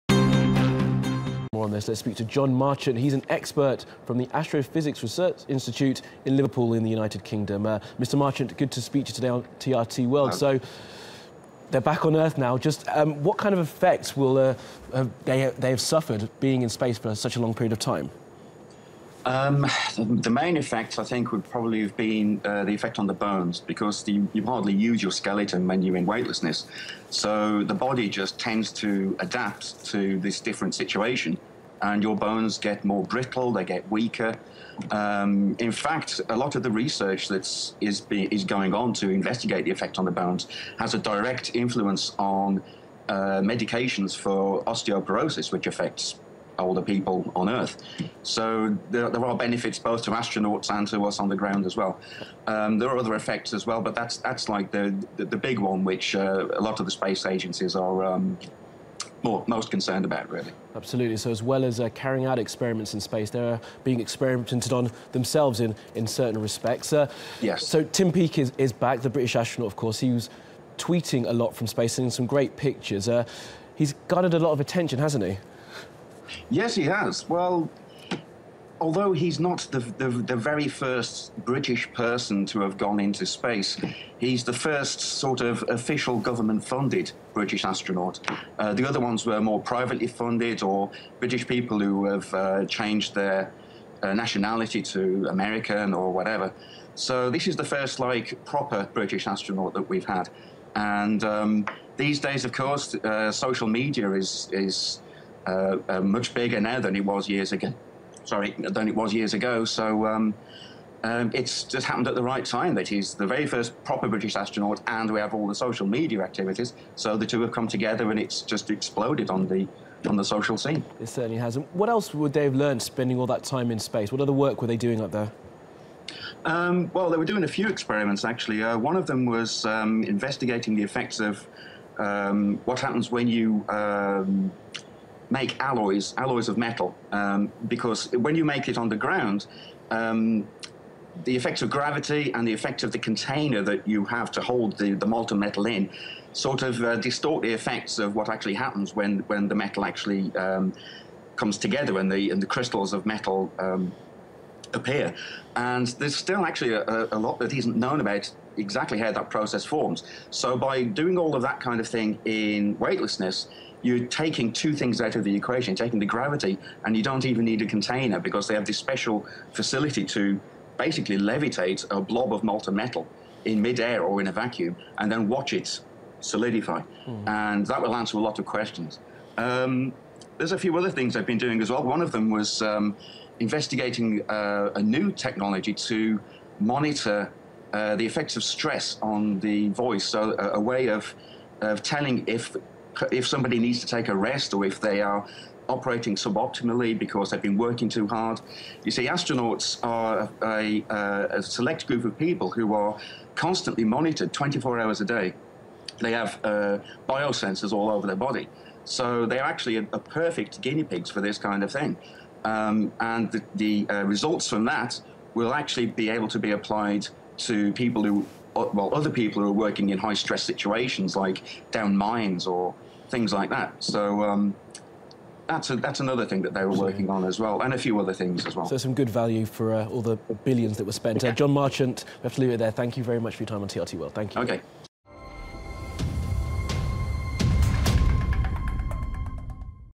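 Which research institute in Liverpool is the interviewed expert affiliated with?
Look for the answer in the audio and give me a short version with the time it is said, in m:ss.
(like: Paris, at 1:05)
Astrophysics Research Institute, at 0:04.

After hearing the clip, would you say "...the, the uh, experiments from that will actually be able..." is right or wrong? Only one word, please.
wrong.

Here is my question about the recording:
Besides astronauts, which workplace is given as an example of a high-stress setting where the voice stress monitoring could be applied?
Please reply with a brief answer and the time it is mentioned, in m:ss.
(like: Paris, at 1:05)
mines, at 3:41.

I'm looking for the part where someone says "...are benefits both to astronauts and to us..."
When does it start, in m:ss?
0:49.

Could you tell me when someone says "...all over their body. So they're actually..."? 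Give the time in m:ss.
3:27.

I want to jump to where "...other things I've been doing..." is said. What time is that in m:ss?
3:00.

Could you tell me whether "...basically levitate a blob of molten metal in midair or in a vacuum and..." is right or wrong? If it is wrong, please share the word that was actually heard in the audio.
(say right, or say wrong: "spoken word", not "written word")
right.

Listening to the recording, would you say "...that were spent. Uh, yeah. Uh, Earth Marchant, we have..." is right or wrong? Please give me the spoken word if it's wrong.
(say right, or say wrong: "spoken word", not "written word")
wrong: "Jon", not "Earth".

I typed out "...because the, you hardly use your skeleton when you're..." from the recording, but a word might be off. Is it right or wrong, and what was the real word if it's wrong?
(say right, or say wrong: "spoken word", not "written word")
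right.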